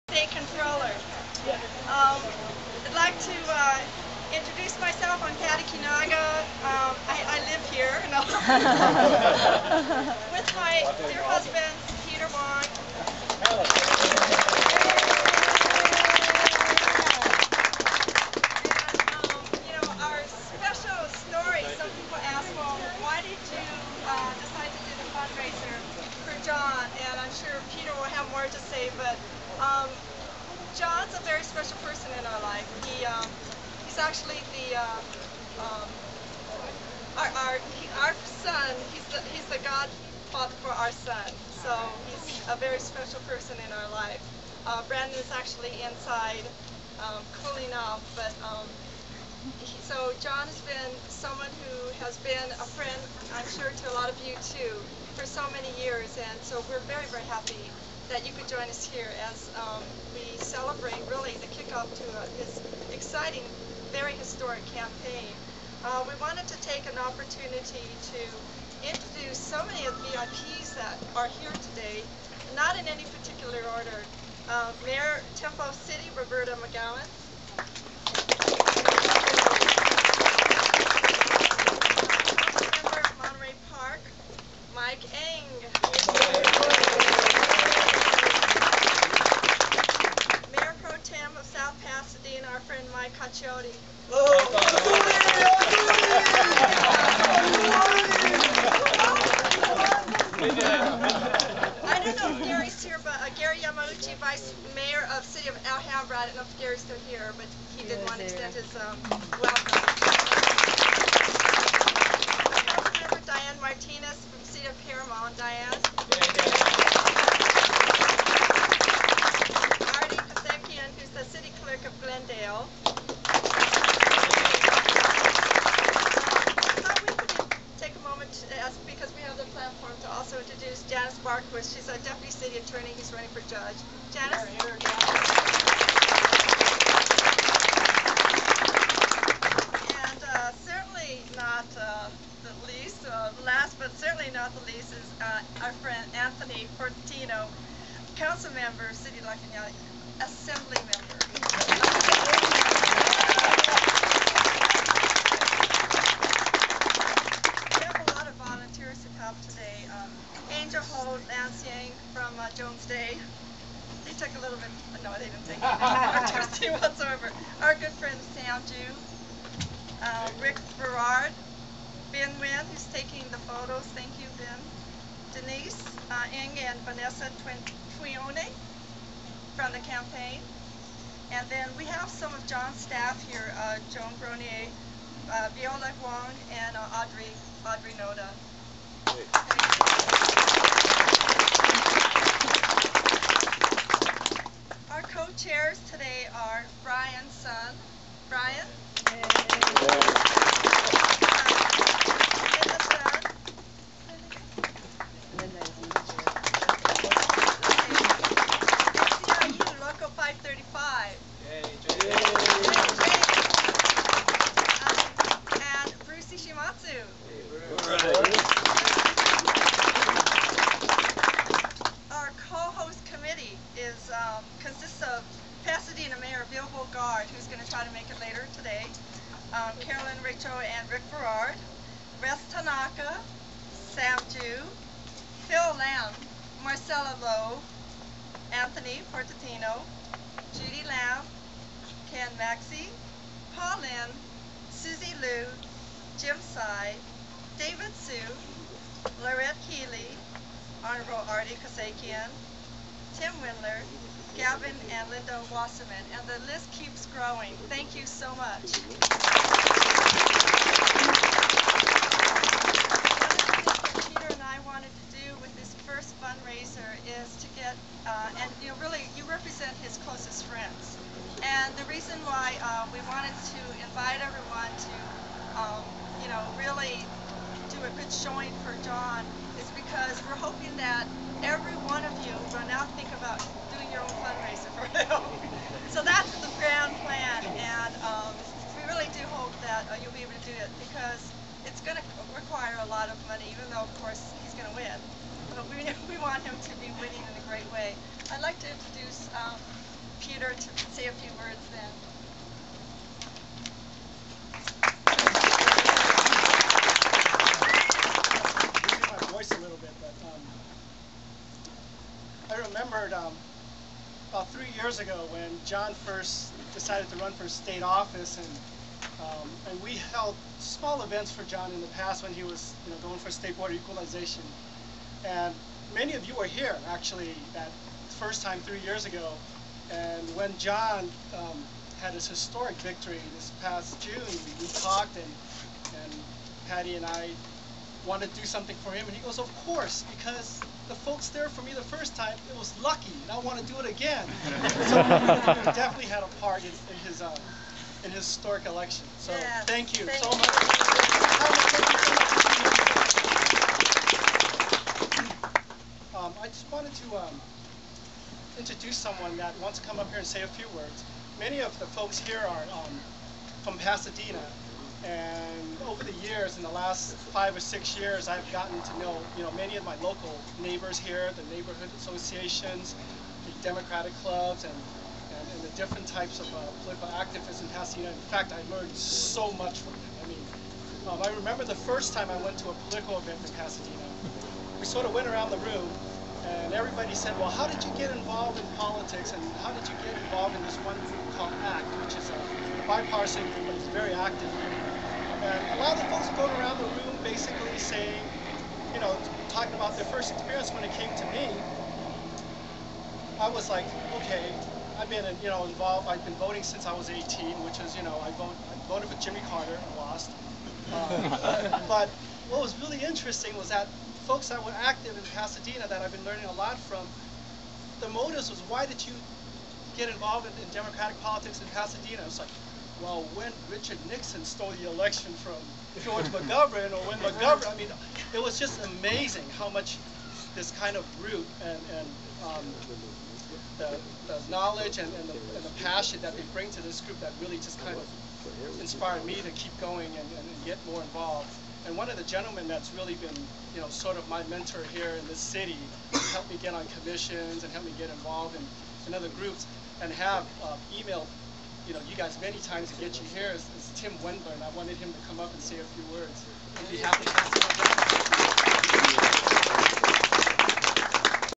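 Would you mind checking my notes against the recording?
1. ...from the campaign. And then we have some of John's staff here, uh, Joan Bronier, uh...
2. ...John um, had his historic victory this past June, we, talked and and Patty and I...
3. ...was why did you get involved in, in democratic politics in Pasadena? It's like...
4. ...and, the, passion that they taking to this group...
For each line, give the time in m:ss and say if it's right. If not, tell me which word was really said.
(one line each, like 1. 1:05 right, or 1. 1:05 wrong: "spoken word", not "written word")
1. 2:59 right
2. 5:30 right
3. 6:58 right
4. 7:15 wrong: "bring", not "taking".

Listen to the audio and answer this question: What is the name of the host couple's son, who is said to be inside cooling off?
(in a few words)
Brandon.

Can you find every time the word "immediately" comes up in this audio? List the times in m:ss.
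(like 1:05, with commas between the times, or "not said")
not said.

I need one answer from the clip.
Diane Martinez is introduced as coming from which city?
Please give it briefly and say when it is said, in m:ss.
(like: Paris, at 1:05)
Paramount, at 1:54.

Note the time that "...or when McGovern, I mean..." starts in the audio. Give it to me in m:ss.
7:06.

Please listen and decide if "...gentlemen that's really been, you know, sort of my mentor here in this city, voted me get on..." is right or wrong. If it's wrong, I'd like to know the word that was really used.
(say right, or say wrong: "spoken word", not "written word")
wrong: "helped", not "voted".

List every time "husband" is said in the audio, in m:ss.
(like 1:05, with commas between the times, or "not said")
0:11.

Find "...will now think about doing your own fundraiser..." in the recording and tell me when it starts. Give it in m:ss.
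4:42.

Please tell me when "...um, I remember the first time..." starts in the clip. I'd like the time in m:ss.
6:21.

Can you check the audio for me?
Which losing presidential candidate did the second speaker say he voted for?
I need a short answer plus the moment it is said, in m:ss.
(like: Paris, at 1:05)
Jimmy Carter, at 6:49.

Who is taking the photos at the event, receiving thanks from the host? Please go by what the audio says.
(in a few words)
Ben Wynn.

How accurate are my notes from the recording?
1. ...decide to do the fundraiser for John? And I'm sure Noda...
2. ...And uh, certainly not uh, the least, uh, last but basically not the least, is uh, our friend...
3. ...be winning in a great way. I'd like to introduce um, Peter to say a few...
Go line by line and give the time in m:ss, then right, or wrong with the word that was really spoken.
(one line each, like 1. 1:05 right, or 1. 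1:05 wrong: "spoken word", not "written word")
1. 0:24 wrong: "Peter", not "Noda"
2. 2:20 wrong: "certainly", not "basically"
3. 4:56 right.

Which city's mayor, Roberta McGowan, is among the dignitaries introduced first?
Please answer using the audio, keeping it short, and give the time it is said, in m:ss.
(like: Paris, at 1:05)
Temple City, at 1:15.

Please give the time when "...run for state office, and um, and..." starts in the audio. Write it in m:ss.
5:17.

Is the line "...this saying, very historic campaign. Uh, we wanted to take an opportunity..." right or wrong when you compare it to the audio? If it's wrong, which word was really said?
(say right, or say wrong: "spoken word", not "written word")
wrong: "exciting", not "saying".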